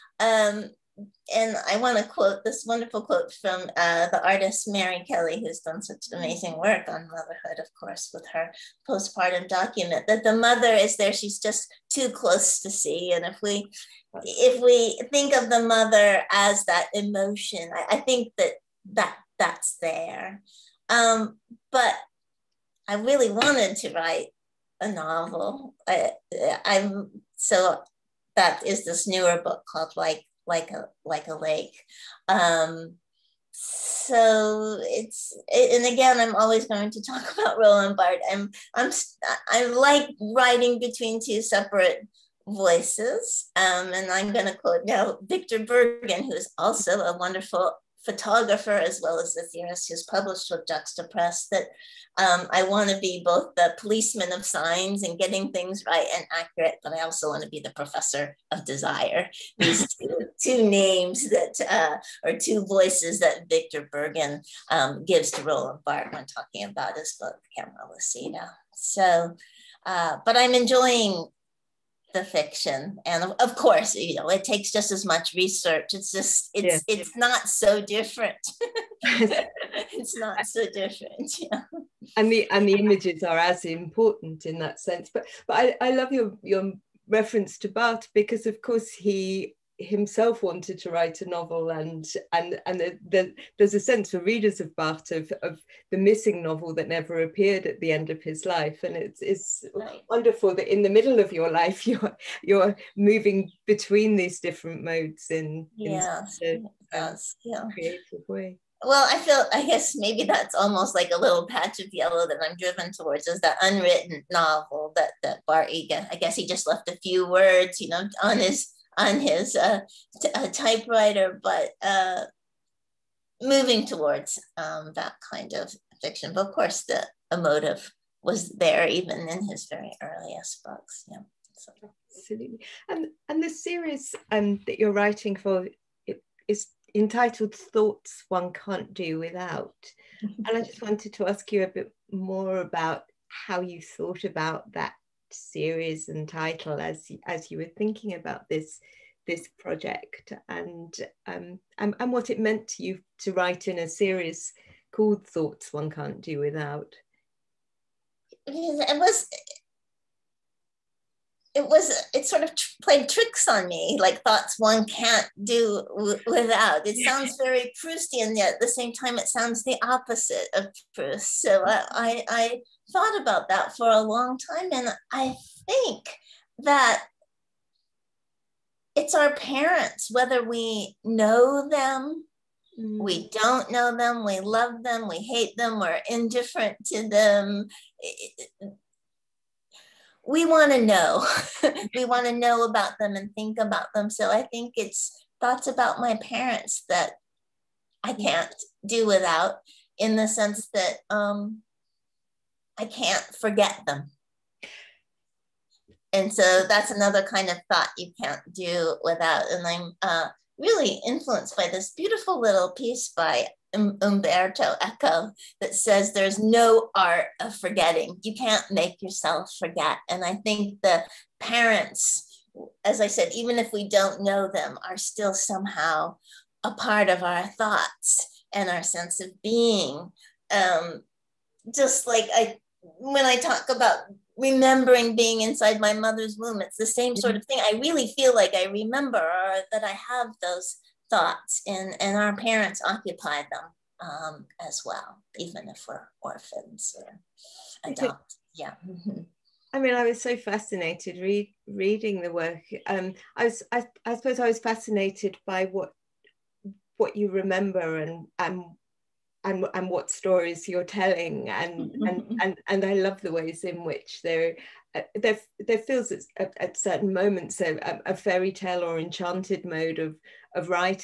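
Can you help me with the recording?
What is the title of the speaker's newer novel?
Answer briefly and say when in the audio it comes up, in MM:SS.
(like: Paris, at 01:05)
Like a Lake, at 00:31.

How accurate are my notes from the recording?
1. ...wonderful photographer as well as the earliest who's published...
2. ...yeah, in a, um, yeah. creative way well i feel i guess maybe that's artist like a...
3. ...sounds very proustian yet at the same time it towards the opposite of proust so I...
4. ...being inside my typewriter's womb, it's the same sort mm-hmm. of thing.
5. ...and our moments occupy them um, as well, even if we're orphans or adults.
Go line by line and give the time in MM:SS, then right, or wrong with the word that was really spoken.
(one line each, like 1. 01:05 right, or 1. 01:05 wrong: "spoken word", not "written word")
1. 00:47 wrong: "theorist", not "earliest"
2. 01:45 wrong: "almost", not "artist"
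3. 02:47 wrong: "sounds", not "towards"
4. 03:55 wrong: "mother", not "typewriter"
5. 04:02 wrong: "parents", not "moments".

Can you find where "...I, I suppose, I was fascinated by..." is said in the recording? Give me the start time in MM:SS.
04:13.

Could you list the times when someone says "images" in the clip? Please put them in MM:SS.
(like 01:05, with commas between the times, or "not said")
01:22.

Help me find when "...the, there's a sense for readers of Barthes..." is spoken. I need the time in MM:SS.
01:33.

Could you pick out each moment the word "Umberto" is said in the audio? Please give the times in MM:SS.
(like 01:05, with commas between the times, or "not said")
03:34.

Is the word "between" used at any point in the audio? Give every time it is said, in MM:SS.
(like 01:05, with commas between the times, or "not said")
00:40, 01:43.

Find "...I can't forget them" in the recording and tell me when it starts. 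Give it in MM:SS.
03:22.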